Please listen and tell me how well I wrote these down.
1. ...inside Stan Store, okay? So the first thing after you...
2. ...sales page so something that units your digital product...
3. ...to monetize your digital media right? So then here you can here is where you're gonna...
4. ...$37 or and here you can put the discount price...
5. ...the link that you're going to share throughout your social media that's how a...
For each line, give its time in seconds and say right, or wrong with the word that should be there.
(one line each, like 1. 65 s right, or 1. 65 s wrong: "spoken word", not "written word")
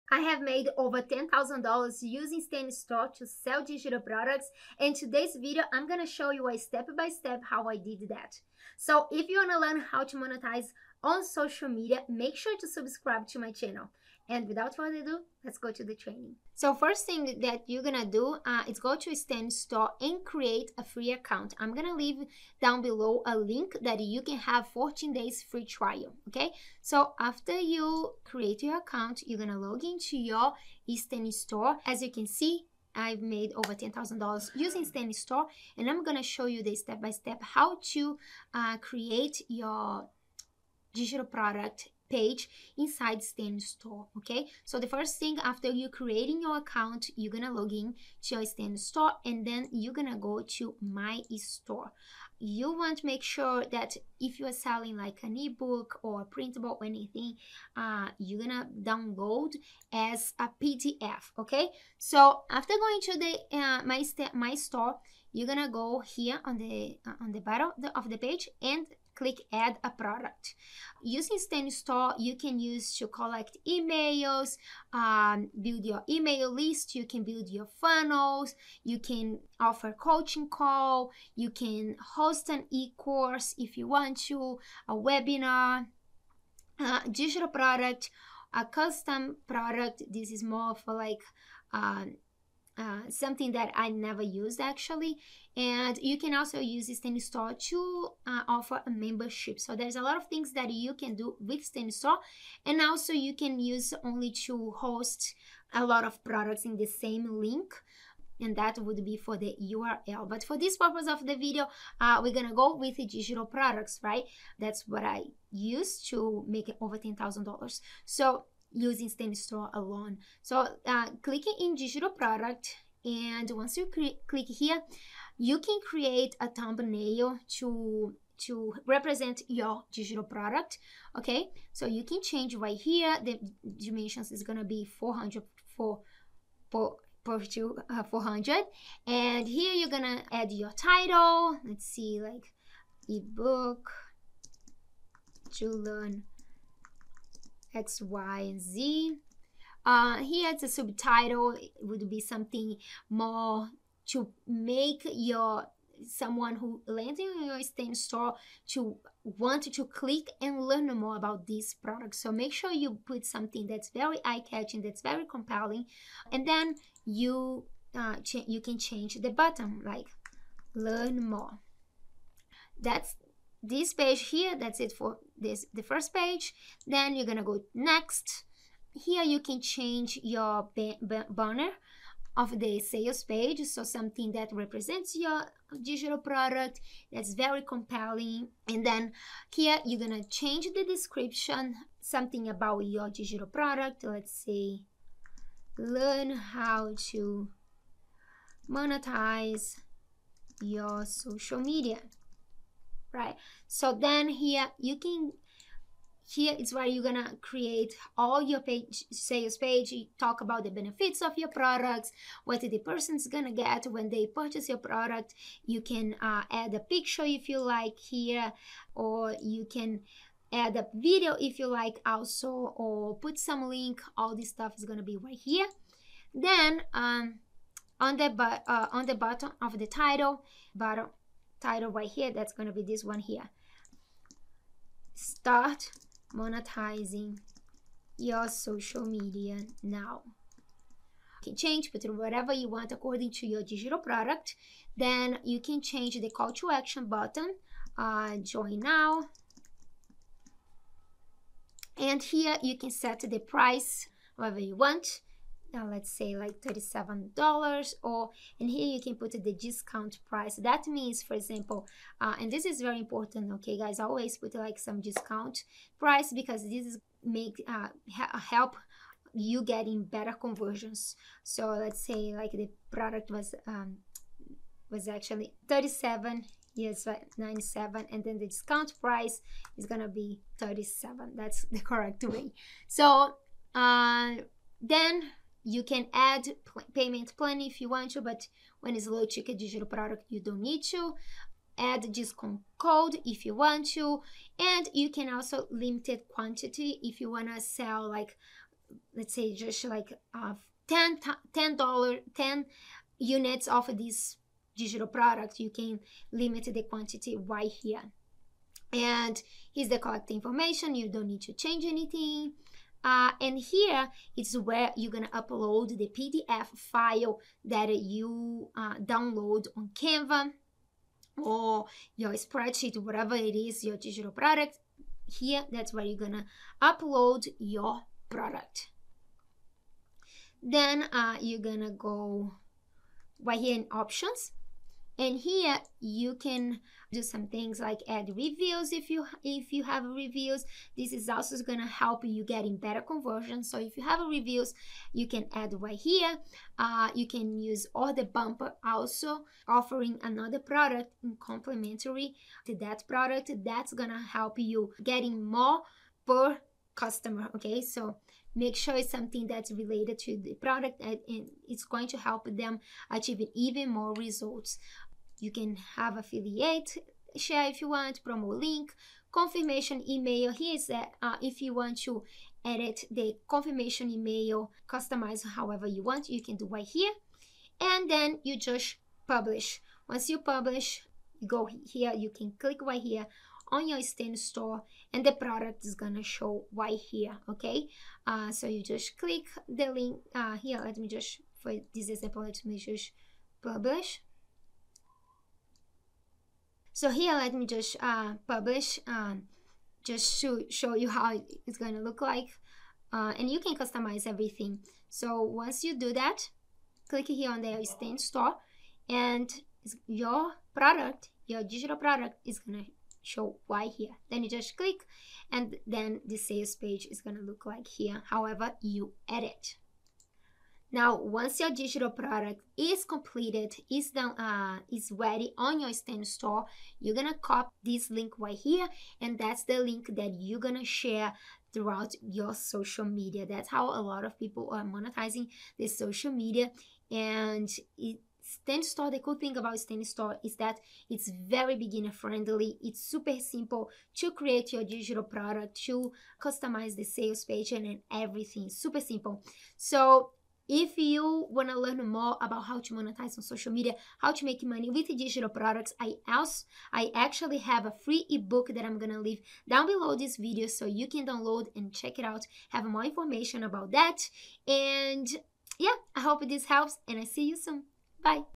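1. 42 s right
2. 182 s wrong: "represents", not "units"
3. 196 s wrong: "social", not "digital"
4. 256 s right
5. 429 s right.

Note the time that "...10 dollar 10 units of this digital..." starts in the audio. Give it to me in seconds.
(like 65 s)
300 s.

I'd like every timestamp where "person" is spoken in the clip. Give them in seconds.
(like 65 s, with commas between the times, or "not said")
212 s.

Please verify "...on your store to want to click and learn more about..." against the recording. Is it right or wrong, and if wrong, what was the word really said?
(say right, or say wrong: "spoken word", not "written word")
right.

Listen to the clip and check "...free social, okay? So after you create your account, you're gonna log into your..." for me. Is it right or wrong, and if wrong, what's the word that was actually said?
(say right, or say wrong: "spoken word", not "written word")
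wrong: "trial", not "social".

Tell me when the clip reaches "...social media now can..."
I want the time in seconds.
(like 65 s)
238 s.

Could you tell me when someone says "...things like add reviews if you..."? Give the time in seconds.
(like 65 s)
337 s.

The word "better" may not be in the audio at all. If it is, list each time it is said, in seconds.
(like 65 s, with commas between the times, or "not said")
270 s, 342 s.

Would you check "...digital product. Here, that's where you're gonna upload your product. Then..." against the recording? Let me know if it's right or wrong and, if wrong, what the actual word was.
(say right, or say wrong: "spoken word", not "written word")
right.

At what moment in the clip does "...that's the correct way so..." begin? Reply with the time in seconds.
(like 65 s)
281 s.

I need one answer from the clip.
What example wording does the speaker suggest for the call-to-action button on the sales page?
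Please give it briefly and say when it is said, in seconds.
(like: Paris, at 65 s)
join now, at 248 s.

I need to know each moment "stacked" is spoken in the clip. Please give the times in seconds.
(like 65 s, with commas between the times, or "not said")
not said.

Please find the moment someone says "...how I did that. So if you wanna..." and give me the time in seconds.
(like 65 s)
7 s.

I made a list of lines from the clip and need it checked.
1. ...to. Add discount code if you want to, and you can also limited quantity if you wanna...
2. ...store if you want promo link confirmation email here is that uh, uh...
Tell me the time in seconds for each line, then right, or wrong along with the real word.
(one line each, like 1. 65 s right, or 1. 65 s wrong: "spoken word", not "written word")
1. 290 s right
2. 367 s wrong: "share", not "store".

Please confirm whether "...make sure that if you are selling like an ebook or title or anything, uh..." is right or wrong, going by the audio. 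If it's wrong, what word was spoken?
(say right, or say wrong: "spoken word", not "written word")
wrong: "printable", not "title".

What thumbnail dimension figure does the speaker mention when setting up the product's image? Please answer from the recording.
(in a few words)
400.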